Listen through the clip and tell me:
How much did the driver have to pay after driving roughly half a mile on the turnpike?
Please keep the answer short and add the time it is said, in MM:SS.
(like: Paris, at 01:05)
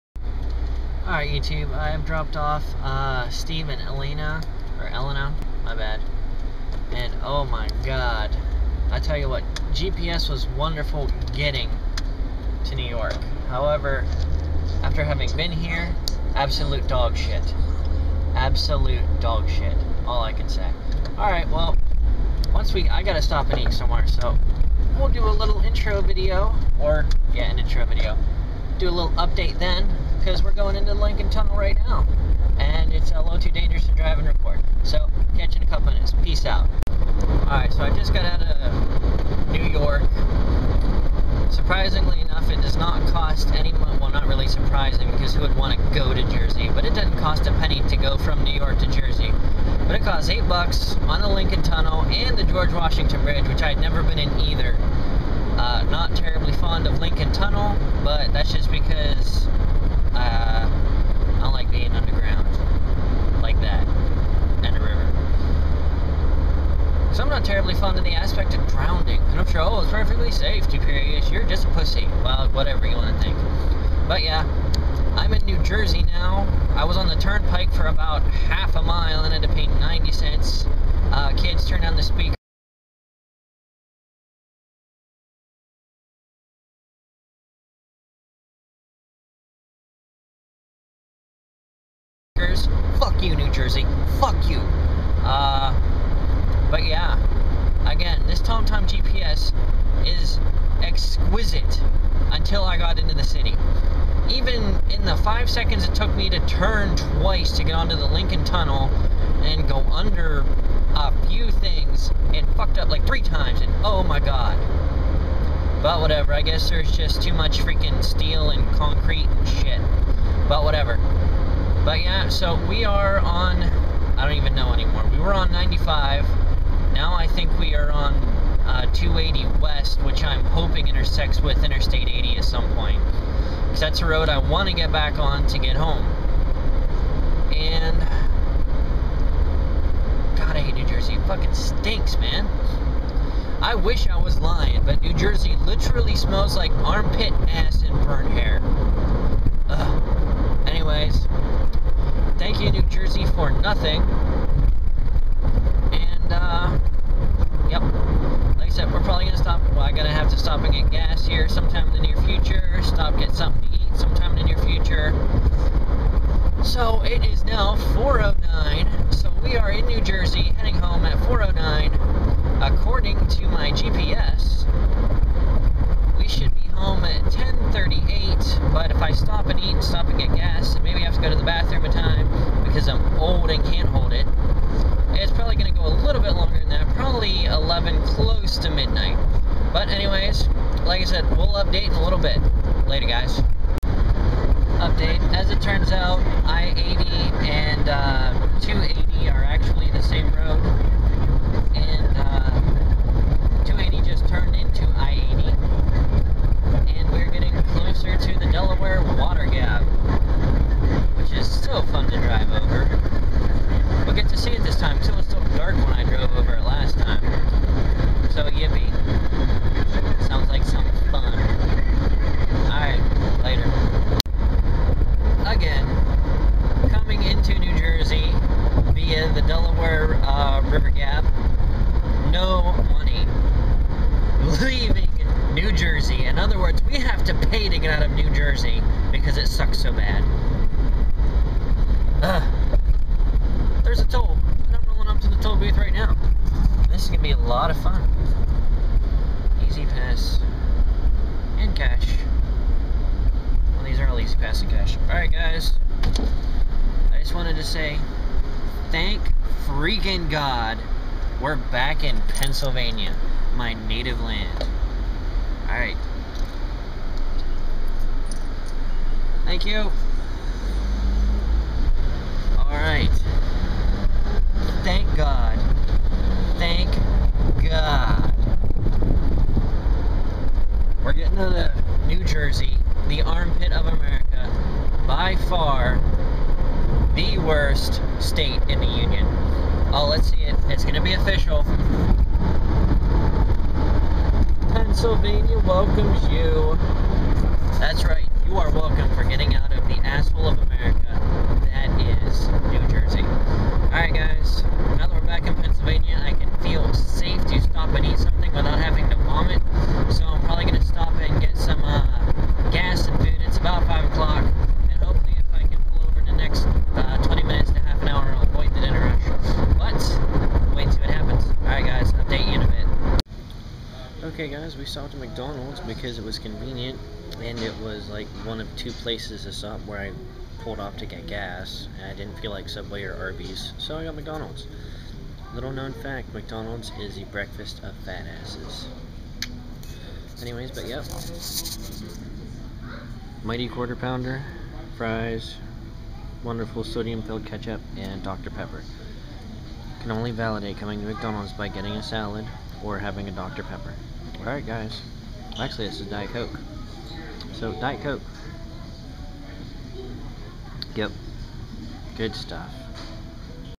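90 cents, at 01:19.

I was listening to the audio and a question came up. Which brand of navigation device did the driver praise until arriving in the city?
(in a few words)
TomTom.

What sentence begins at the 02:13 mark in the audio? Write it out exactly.
Because that's a road I want to get back on to get home.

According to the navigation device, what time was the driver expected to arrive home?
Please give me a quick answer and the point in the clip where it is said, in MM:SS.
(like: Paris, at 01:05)
10:38, at 02:57.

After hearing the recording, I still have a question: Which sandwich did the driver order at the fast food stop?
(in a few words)
Mighty Quarter Pounder.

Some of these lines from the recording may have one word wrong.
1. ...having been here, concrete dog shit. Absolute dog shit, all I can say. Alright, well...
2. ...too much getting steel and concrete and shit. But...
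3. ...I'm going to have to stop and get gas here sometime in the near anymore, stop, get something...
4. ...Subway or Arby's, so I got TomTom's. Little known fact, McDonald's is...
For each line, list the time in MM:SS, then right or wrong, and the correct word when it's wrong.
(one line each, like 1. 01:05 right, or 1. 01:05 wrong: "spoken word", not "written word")
1. 00:15 wrong: "absolute", not "concrete"
2. 01:57 wrong: "freaking", not "getting"
3. 02:39 wrong: "future", not "anymore"
4. 05:32 wrong: "McDonald", not "TomTom".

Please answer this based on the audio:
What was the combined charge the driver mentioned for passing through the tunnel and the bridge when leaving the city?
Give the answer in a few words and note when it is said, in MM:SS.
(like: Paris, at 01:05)
$8, at 00:50.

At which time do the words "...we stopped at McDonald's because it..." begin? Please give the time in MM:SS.
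05:24.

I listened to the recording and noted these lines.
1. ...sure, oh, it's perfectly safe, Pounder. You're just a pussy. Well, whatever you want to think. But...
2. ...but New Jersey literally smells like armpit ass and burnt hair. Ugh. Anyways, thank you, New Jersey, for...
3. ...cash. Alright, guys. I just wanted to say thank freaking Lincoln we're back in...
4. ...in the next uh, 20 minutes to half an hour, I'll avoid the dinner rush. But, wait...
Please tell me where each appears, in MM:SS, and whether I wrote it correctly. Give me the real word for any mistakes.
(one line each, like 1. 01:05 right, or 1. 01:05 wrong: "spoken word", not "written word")
1. 01:09 wrong: "Tuperius", not "Pounder"
2. 02:24 right
3. 04:14 wrong: "God", not "Lincoln"
4. 05:16 right.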